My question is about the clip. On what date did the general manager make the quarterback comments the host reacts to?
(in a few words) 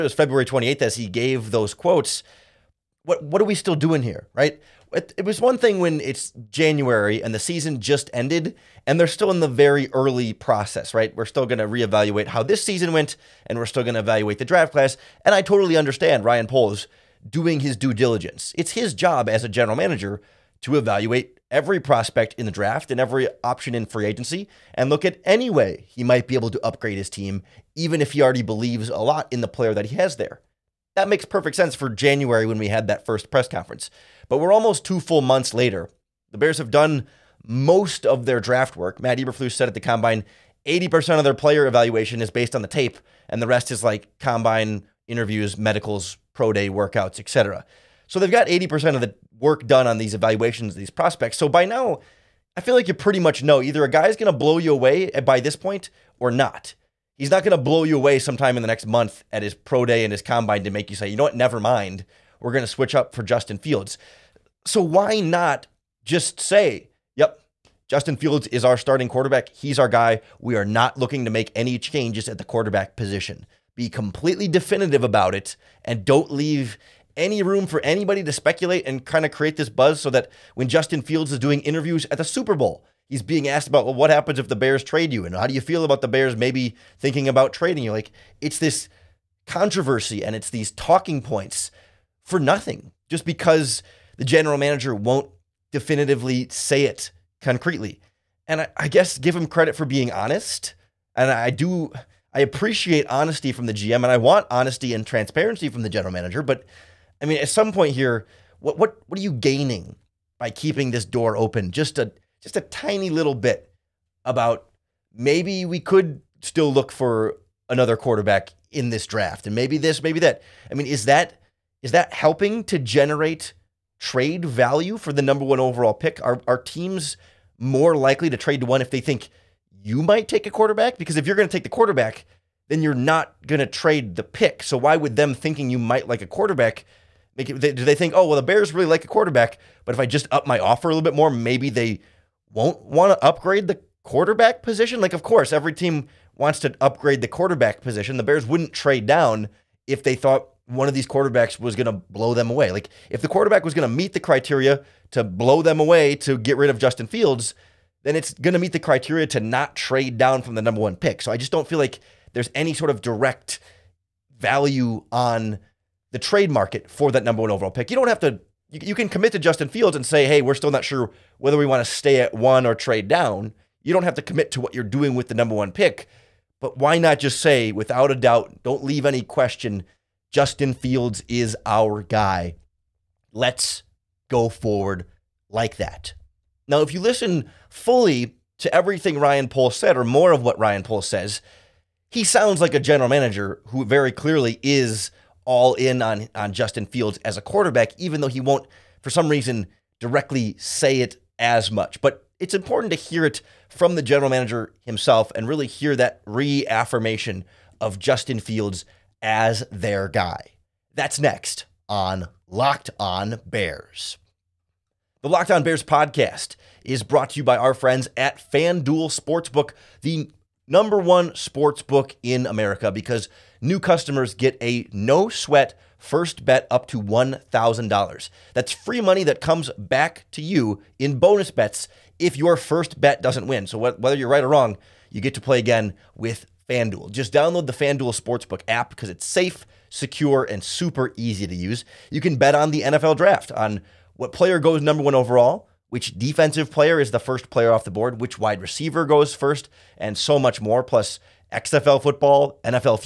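February 28th.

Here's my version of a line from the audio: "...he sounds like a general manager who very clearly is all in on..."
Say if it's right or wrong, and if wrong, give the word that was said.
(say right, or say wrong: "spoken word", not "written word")
right.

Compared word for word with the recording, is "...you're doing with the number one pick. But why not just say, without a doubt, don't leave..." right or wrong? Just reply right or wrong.
right.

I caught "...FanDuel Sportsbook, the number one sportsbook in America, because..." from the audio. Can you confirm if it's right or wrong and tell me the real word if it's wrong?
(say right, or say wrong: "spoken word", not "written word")
right.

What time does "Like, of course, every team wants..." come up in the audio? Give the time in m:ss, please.
2:25.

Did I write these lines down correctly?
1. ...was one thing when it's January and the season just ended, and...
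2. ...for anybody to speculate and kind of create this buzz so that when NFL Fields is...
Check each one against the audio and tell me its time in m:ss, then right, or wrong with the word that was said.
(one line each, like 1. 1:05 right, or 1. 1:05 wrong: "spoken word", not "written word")
1. 0:05 right
2. 1:17 wrong: "Justin", not "NFL".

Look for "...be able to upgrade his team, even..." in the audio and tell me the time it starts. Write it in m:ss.
0:26.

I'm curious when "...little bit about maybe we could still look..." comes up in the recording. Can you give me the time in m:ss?
1:53.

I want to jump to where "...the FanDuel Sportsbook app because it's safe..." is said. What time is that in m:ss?
3:57.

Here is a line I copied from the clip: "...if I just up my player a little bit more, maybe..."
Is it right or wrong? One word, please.
wrong.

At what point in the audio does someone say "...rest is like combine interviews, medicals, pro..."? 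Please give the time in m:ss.
0:43.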